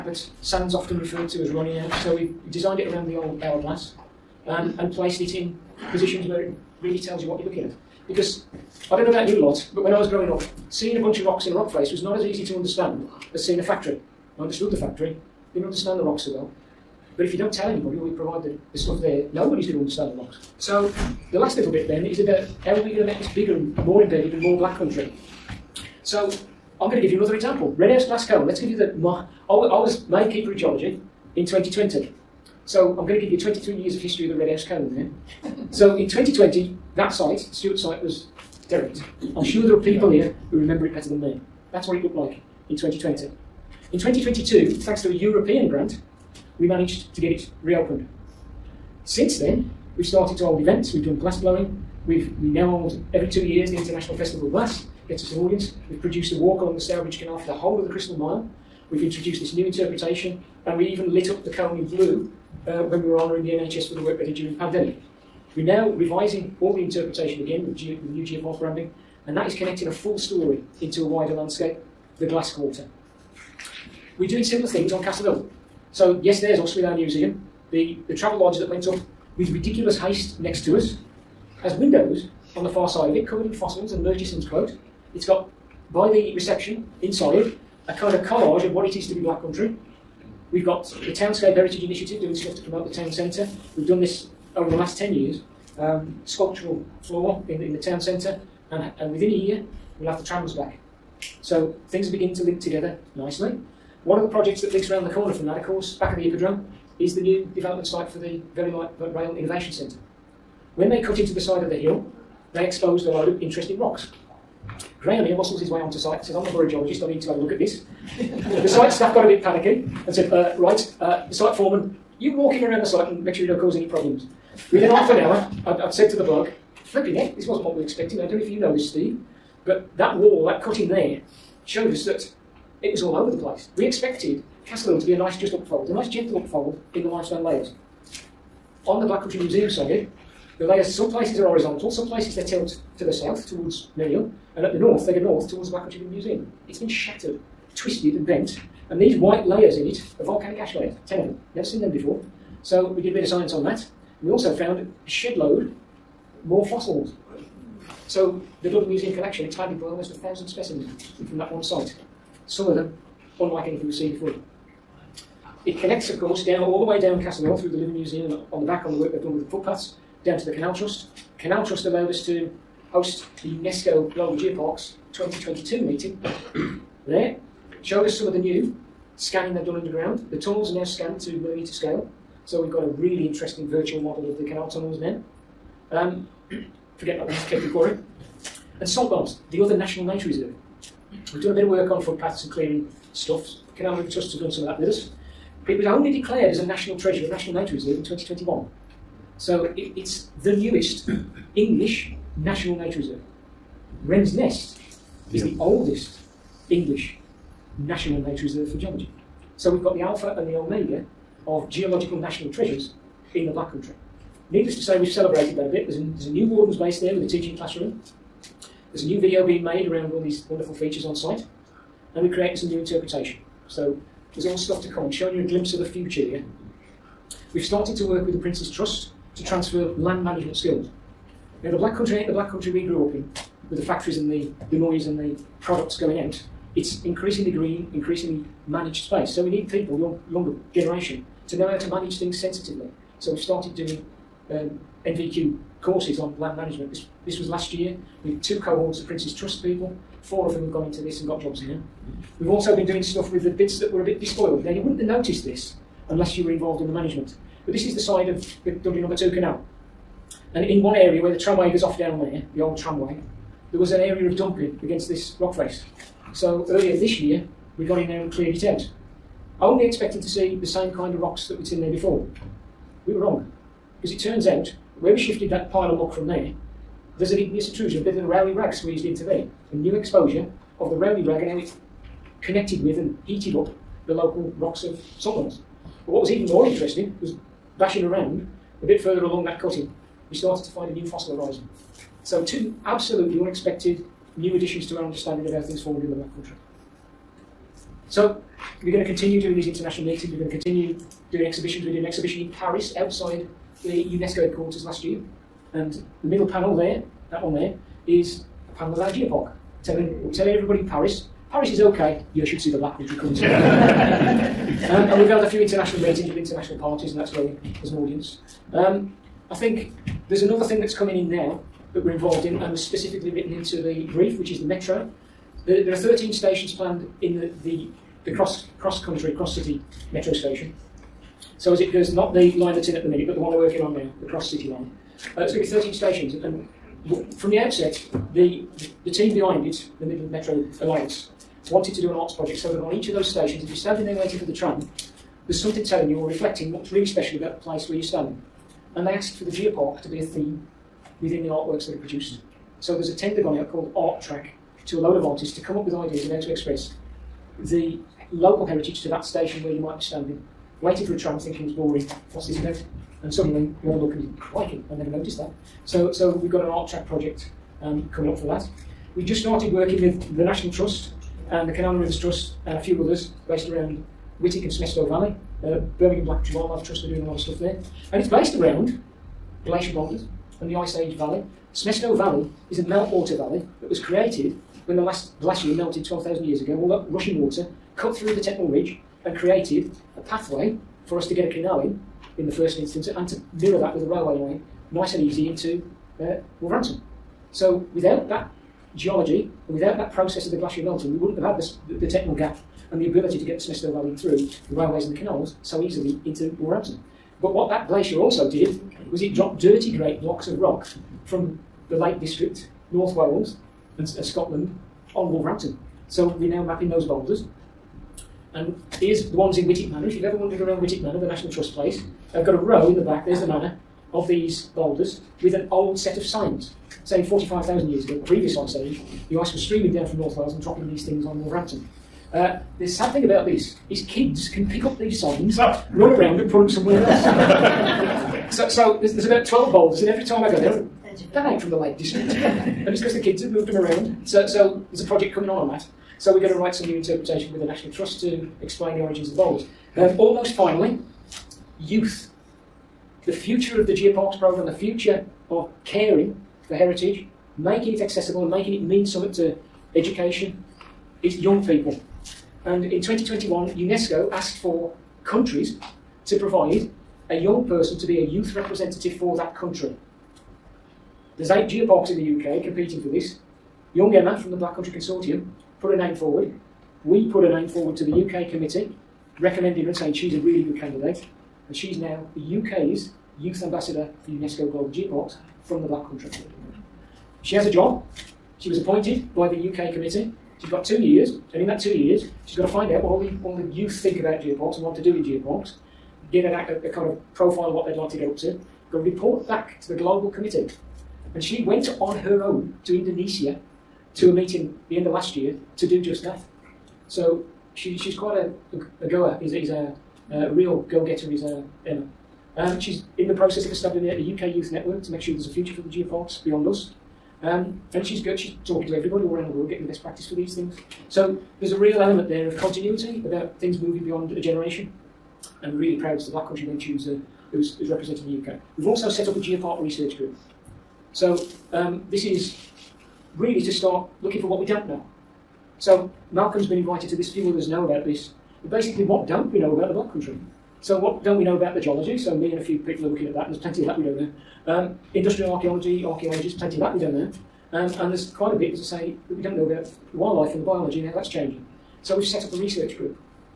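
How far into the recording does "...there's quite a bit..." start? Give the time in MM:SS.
09:08.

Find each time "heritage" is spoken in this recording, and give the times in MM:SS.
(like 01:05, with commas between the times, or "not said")
01:31, 05:58, 07:36.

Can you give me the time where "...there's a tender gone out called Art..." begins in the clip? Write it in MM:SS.
05:52.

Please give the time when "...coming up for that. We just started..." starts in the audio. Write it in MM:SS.
06:08.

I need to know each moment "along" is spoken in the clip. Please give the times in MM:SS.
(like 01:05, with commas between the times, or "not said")
00:56, 04:49.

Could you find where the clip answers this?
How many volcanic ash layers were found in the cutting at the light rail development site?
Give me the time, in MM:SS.
02:31.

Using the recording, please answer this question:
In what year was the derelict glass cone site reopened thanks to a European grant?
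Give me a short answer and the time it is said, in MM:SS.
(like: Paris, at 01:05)
2022, at 00:43.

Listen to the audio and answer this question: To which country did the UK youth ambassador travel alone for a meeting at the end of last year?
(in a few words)
Indonesia.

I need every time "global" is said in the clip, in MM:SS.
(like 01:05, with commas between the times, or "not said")
02:54, 08:04, 08:19.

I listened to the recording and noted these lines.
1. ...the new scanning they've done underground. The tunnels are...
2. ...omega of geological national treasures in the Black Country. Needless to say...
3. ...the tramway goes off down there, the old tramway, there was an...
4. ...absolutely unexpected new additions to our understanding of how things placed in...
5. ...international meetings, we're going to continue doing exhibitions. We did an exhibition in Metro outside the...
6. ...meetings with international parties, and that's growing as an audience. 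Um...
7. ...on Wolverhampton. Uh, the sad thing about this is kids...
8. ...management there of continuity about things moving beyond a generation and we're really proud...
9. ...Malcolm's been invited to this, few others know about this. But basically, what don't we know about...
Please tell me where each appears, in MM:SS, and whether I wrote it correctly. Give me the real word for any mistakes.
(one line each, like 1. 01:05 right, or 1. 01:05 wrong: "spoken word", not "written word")
1. 02:58 right
2. 03:30 right
3. 04:21 right
4. 04:52 wrong: "formed", not "placed"
5. 04:59 wrong: "Paris", not "Metro"
6. 05:15 right
7. 07:11 right
8. 08:42 wrong: "element", not "management"
9. 08:56 right.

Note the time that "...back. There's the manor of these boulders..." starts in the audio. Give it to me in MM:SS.
07:03.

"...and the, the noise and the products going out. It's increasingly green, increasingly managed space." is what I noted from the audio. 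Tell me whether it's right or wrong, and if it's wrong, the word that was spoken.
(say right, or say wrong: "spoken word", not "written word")
right.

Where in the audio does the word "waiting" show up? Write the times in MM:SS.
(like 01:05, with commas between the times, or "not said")
05:44, 06:00.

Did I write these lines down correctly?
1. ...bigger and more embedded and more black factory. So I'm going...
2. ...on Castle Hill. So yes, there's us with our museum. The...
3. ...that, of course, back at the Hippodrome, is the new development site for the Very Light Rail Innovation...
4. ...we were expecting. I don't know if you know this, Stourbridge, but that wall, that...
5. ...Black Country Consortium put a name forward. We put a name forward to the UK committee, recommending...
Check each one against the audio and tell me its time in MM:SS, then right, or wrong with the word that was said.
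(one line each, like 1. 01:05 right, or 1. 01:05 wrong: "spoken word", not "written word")
1. 00:23 wrong: "country", not "factory"
2. 01:14 right
3. 01:45 right
4. 02:07 wrong: "Steve", not "Stourbridge"
5. 07:54 right.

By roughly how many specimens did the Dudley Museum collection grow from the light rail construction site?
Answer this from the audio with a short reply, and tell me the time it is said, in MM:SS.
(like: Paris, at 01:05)
Almost a thousand, at 02:39.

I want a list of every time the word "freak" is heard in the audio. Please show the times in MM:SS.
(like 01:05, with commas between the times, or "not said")
not said.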